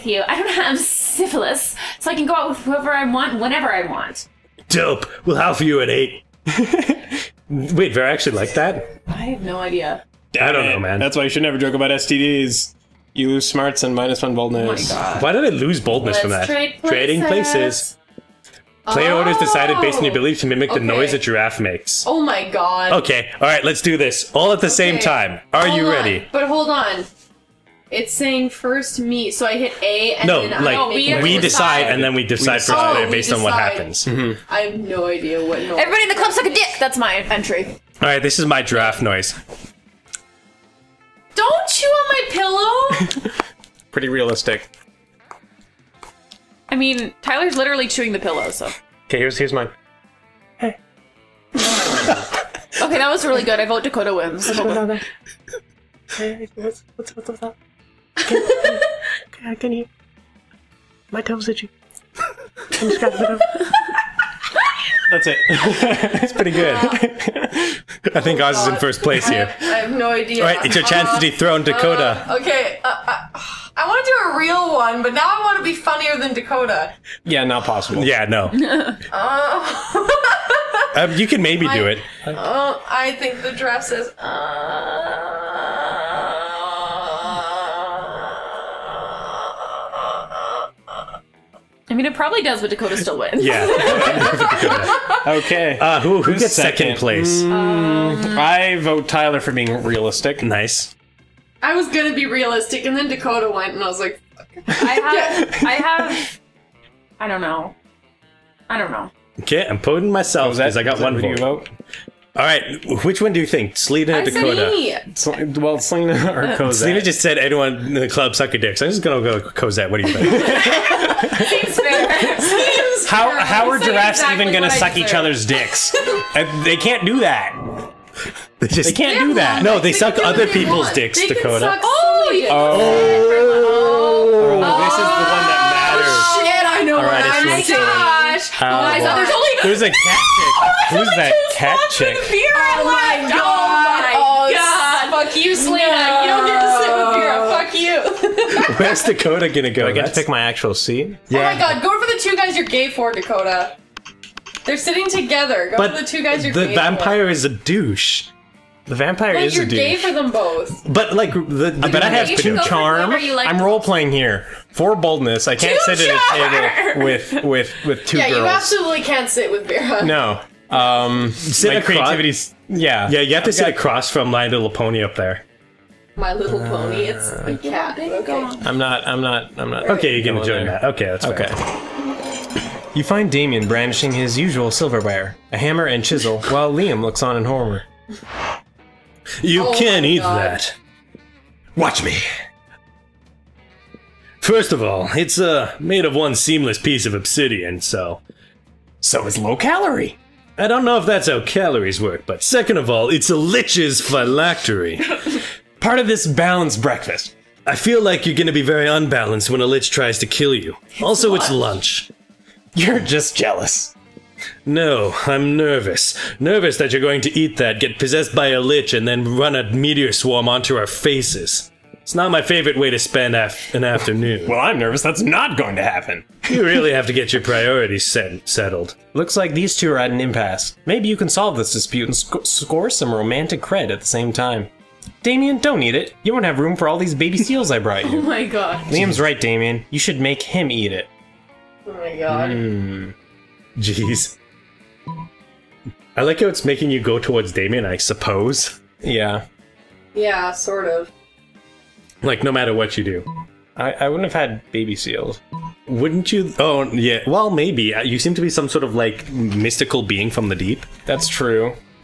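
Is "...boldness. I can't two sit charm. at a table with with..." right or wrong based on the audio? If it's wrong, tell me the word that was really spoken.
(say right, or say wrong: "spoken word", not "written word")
right.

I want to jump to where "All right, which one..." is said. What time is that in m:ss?
1:52.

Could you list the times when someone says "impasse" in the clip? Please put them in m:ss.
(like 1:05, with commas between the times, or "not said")
3:50.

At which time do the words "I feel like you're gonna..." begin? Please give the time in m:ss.
3:27.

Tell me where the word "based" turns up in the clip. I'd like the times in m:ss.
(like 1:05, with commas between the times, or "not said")
0:19, 0:33.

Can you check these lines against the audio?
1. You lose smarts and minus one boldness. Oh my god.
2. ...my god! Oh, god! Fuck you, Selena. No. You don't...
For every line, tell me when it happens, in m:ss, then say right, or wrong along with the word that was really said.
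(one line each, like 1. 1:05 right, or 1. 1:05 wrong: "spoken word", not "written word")
1. 0:13 right
2. 2:22 right.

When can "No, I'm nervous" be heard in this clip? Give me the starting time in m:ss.
3:34.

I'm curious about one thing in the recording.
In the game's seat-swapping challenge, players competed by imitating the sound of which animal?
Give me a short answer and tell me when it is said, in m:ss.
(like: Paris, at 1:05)
giraffe, at 0:21.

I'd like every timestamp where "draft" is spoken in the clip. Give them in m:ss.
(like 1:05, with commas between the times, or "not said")
0:38, 1:23.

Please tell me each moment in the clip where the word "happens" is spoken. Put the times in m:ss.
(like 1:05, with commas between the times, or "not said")
0:33, 3:45.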